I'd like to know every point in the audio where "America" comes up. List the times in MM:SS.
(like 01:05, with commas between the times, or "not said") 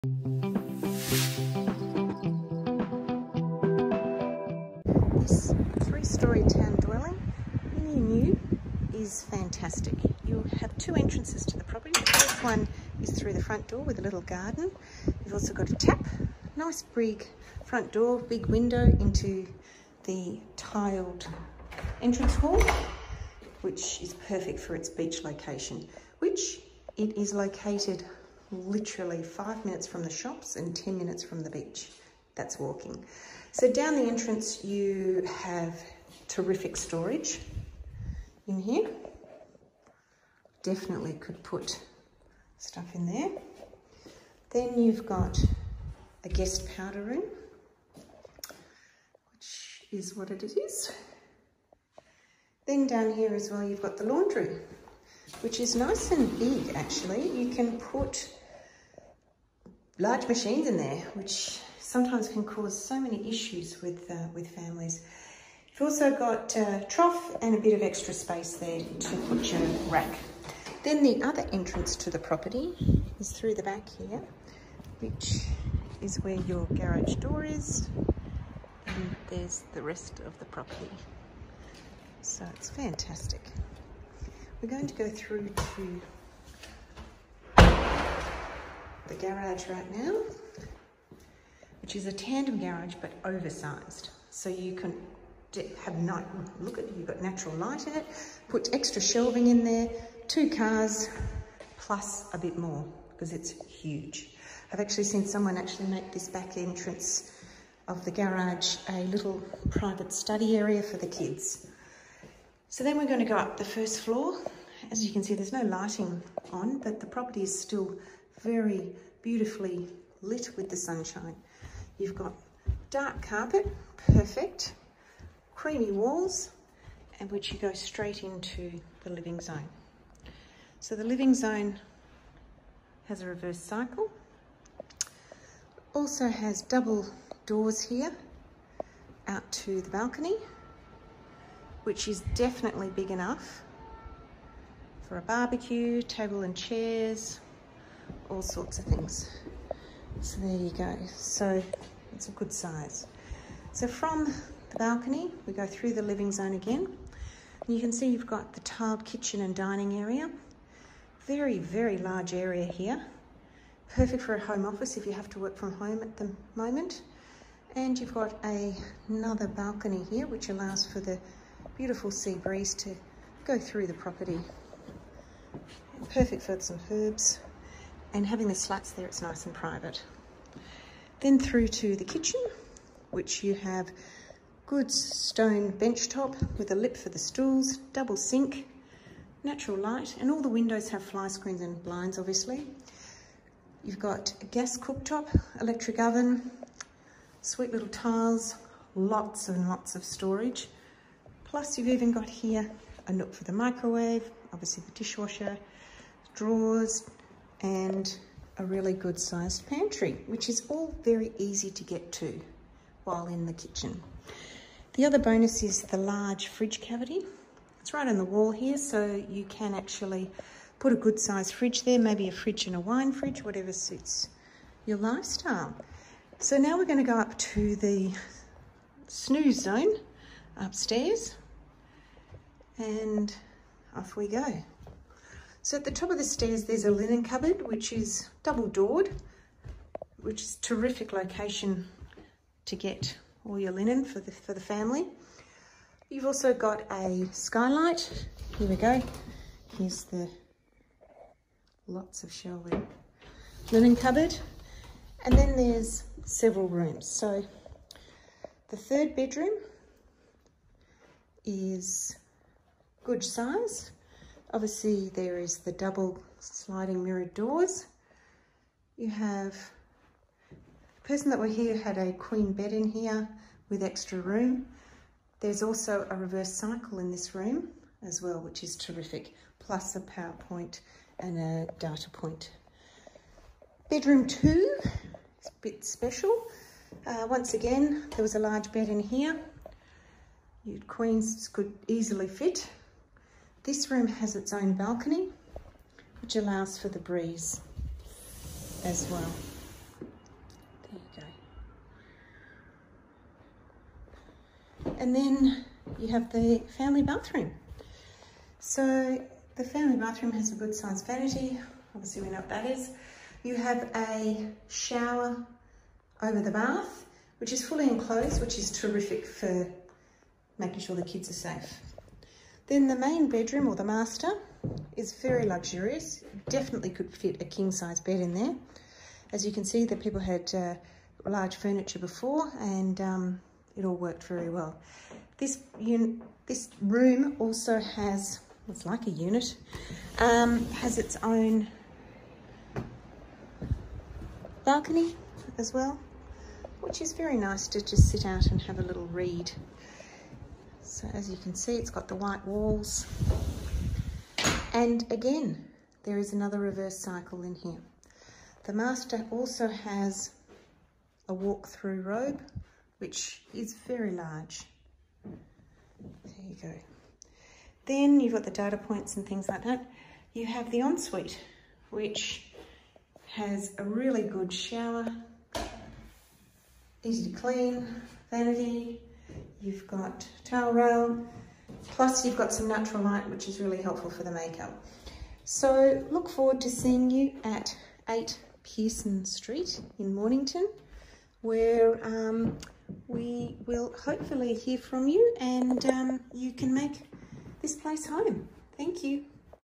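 not said.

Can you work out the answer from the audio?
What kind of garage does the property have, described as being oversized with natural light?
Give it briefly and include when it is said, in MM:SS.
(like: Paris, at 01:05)
Tandem garage, at 01:32.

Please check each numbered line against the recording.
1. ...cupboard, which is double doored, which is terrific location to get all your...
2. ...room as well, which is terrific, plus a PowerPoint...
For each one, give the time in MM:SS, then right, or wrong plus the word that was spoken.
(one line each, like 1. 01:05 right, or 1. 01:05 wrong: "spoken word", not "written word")
1. 03:57 right
2. 04:37 right.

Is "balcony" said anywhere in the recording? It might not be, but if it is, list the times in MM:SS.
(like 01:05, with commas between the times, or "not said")
02:19, 02:34, 02:49, 04:54, 05:44.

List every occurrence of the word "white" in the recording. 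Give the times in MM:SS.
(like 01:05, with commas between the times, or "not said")
05:52.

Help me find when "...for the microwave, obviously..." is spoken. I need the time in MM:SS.
03:23.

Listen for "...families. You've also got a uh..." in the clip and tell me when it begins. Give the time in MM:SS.
01:04.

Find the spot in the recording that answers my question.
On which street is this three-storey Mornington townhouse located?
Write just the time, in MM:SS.
06:28.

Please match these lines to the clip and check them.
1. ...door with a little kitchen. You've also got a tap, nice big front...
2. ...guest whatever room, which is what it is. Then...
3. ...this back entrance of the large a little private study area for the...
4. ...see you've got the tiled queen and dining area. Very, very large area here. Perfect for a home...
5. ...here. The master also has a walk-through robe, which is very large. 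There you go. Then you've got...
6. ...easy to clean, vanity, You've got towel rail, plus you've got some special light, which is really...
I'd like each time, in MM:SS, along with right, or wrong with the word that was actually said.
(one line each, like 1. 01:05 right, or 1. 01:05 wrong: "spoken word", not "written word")
1. 00:13 wrong: "garden", not "kitchen"
2. 00:46 wrong: "powder", not "whatever"
3. 01:46 wrong: "garage", not "large"
4. 02:37 wrong: "kitchen", not "queen"
5. 05:57 right
6. 06:17 wrong: "natural", not "special".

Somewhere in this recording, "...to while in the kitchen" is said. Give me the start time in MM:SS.
03:32.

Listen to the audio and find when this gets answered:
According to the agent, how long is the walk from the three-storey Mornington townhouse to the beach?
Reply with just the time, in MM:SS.
00:30.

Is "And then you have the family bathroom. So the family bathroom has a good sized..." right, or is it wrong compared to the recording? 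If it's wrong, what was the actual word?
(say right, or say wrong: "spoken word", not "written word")
right.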